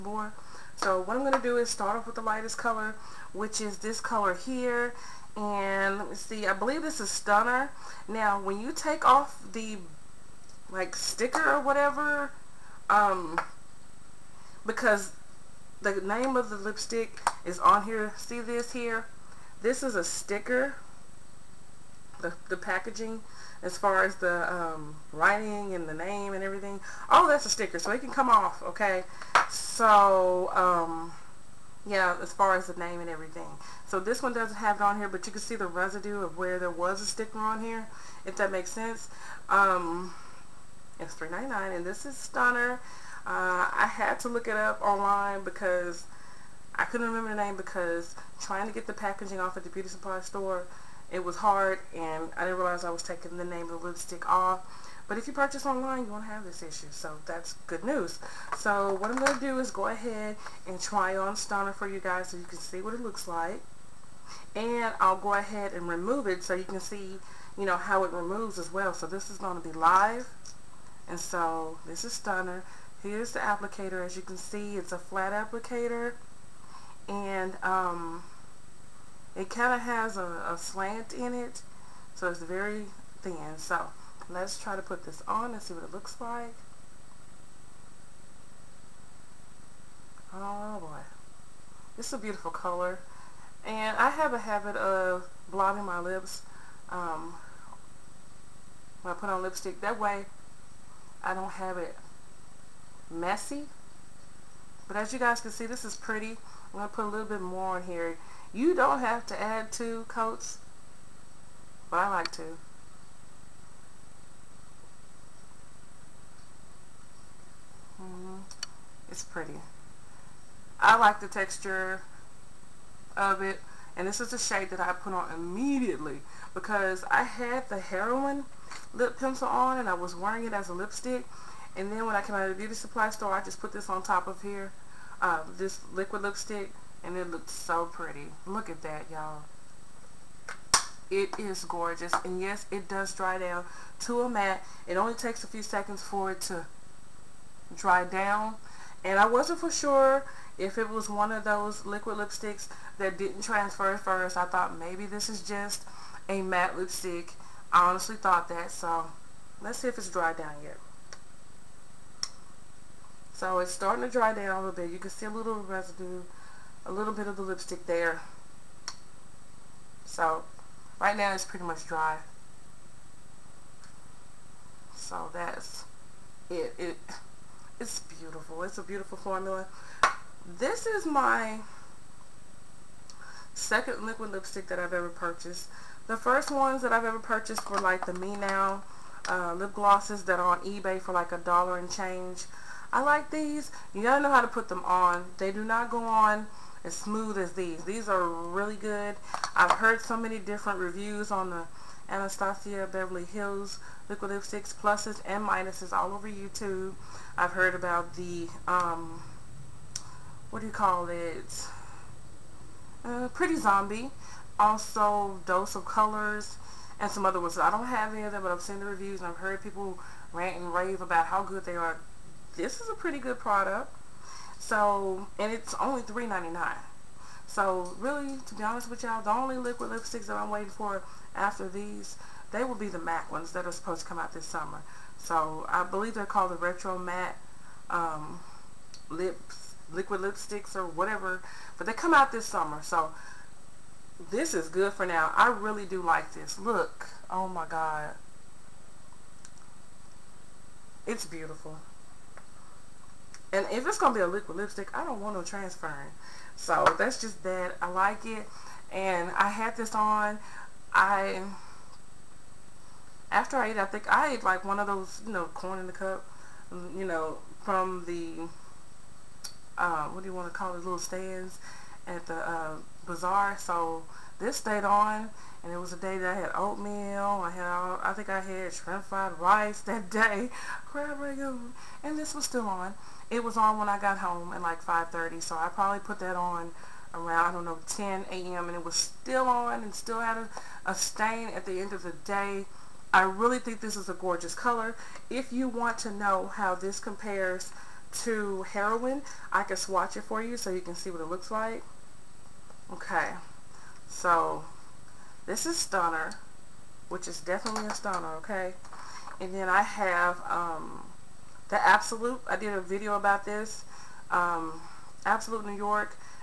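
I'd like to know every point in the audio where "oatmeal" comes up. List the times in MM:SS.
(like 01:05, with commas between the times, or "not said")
04:36.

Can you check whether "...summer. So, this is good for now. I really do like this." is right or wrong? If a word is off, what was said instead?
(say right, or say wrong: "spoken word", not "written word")
right.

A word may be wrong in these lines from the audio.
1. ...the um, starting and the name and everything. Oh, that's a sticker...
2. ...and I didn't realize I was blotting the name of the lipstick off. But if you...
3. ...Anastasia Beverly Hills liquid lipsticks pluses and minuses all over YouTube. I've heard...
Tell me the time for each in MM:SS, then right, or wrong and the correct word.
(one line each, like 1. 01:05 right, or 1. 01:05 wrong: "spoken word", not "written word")
1. 00:24 wrong: "writing", not "starting"
2. 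00:51 wrong: "taking", not "blotting"
3. 03:22 right.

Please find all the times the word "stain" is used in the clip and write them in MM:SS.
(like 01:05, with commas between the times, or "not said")
04:50.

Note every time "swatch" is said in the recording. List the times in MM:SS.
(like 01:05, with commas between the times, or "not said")
04:59.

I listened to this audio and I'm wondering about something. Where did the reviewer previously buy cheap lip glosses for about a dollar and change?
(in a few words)
eBay.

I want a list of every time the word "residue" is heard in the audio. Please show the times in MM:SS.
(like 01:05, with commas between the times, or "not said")
00:35, 02:45.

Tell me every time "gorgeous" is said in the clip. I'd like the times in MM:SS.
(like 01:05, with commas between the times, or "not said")
02:21, 04:54.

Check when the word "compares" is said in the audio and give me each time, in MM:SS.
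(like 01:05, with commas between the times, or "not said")
04:56.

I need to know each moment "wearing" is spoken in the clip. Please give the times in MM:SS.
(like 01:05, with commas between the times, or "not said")
02:10.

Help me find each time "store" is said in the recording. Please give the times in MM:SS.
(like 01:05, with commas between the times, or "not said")
00:50, 02:13.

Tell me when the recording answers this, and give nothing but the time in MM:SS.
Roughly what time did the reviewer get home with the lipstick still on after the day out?
04:44.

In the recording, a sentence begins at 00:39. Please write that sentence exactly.
Um, it's $3.99, and this is Stunner.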